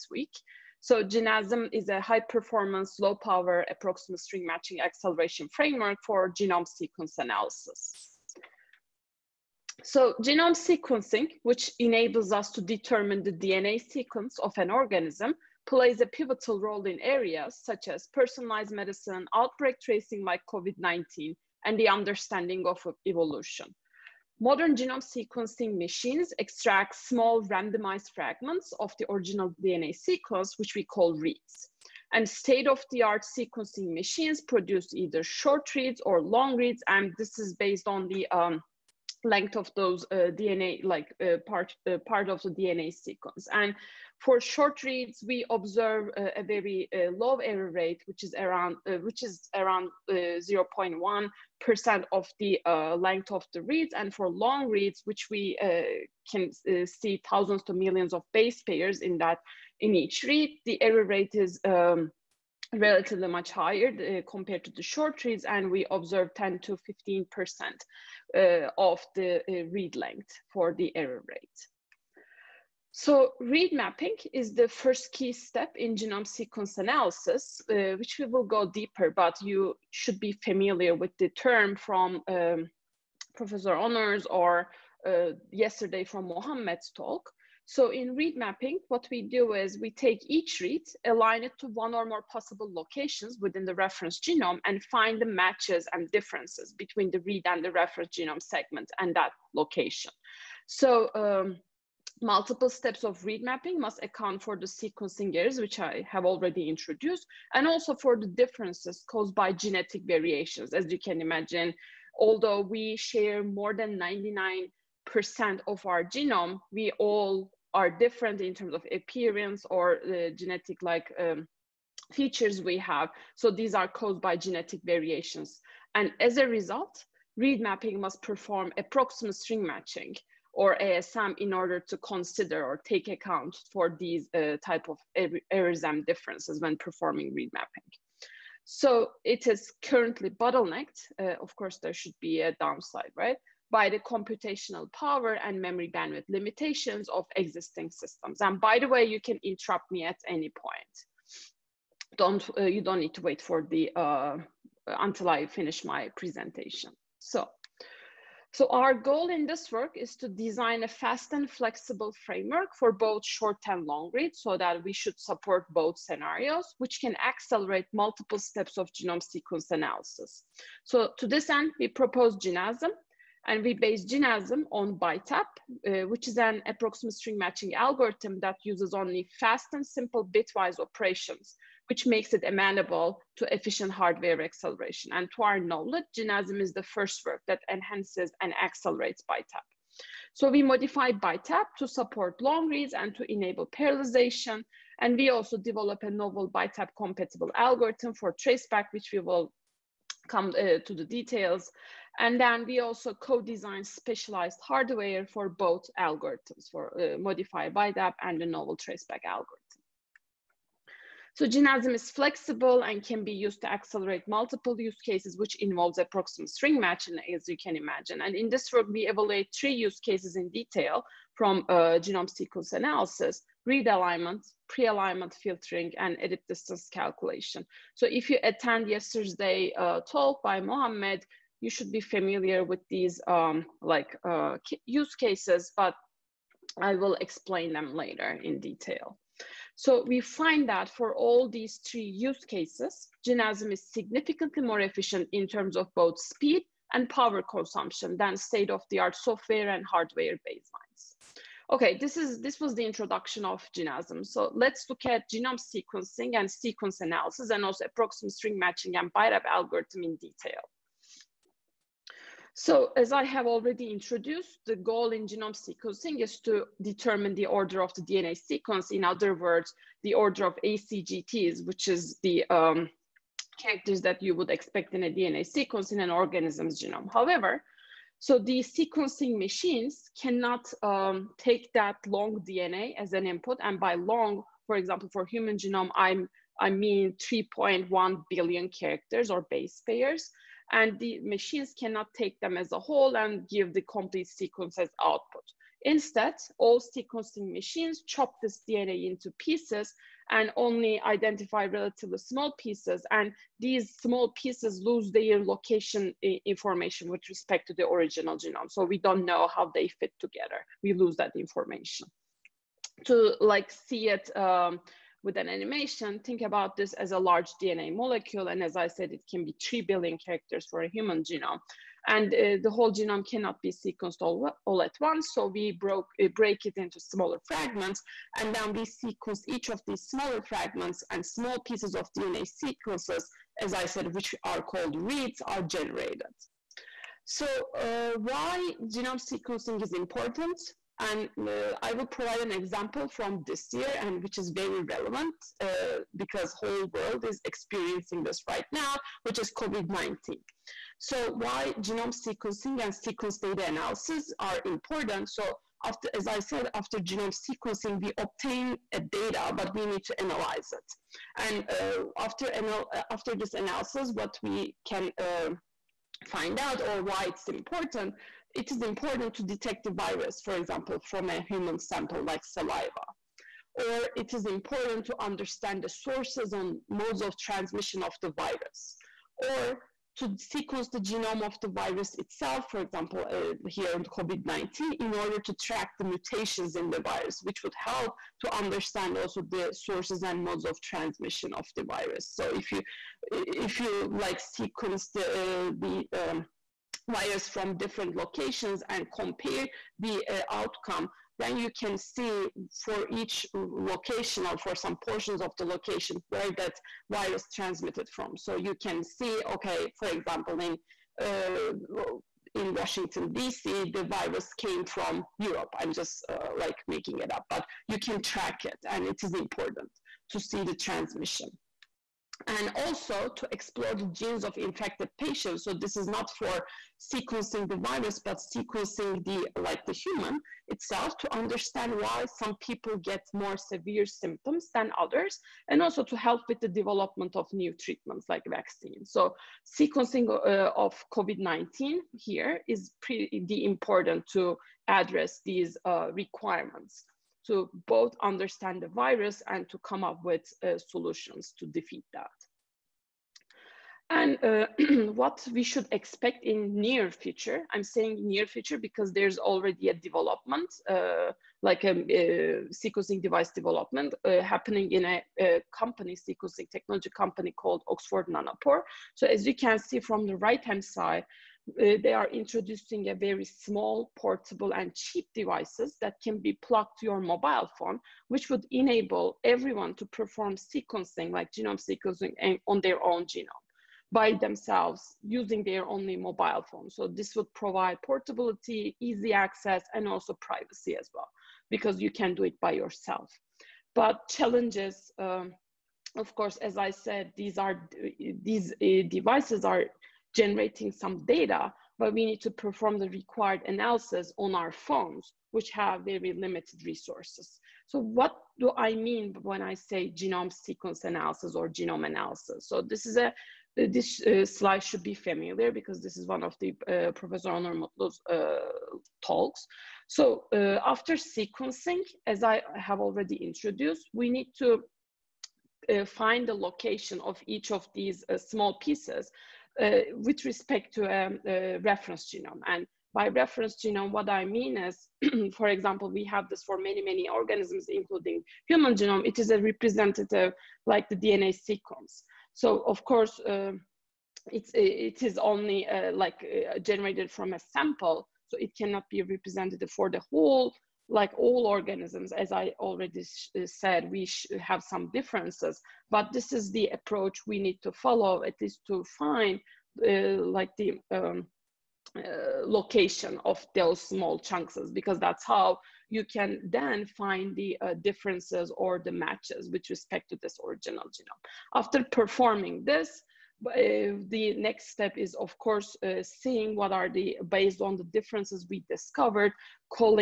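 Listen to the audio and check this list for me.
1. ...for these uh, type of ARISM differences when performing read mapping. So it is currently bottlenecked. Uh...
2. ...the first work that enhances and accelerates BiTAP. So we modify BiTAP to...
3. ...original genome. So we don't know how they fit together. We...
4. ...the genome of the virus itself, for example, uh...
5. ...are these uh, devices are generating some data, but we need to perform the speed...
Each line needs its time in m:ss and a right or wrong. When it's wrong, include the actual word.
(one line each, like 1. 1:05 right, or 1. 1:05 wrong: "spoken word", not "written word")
1. 2:13 right
2. 3:06 right
3. 5:07 right
4. 6:20 right
5. 8:17 wrong: "required", not "speed".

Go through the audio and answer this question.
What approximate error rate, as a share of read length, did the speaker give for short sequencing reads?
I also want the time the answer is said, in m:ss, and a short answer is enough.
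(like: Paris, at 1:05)
0.1 percent, at 0:50.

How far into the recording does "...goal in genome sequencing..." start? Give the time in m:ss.
4:24.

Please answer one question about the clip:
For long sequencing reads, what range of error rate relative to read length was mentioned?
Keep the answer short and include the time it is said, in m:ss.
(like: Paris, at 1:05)
10 to 15 percent, at 1:06.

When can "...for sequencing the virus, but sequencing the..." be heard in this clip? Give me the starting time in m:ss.
7:06.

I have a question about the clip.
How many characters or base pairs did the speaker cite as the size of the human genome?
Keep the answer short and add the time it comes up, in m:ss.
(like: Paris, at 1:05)
3.1 billion, at 4:47.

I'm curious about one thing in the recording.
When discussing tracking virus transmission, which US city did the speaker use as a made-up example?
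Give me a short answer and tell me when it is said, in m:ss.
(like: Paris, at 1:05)
Washington DC, at 6:52.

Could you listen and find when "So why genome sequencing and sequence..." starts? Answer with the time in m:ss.
5:50.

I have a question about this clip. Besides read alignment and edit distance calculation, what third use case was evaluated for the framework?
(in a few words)
Pre-alignment filtering.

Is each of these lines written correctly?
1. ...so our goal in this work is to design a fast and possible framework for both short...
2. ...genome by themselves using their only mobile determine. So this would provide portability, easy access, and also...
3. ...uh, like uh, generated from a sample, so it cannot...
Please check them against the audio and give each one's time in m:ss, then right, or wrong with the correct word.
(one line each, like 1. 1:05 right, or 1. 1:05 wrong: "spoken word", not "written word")
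1. 2:38 wrong: "flexible", not "possible"
2. 8:03 wrong: "phone", not "determine"
3. 9:05 right.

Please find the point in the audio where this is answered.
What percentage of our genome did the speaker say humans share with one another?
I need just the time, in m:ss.
1:53.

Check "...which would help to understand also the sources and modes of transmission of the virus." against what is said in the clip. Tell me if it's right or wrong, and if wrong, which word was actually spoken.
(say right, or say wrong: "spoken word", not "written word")
right.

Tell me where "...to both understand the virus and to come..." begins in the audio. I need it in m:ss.
7:27.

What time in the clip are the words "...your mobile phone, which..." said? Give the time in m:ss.
7:57.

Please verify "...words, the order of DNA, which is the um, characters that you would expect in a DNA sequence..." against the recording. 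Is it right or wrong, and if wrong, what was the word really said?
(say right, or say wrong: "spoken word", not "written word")
wrong: "ACGTs", not "DNA".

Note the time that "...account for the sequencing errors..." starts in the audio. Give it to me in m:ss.
1:44.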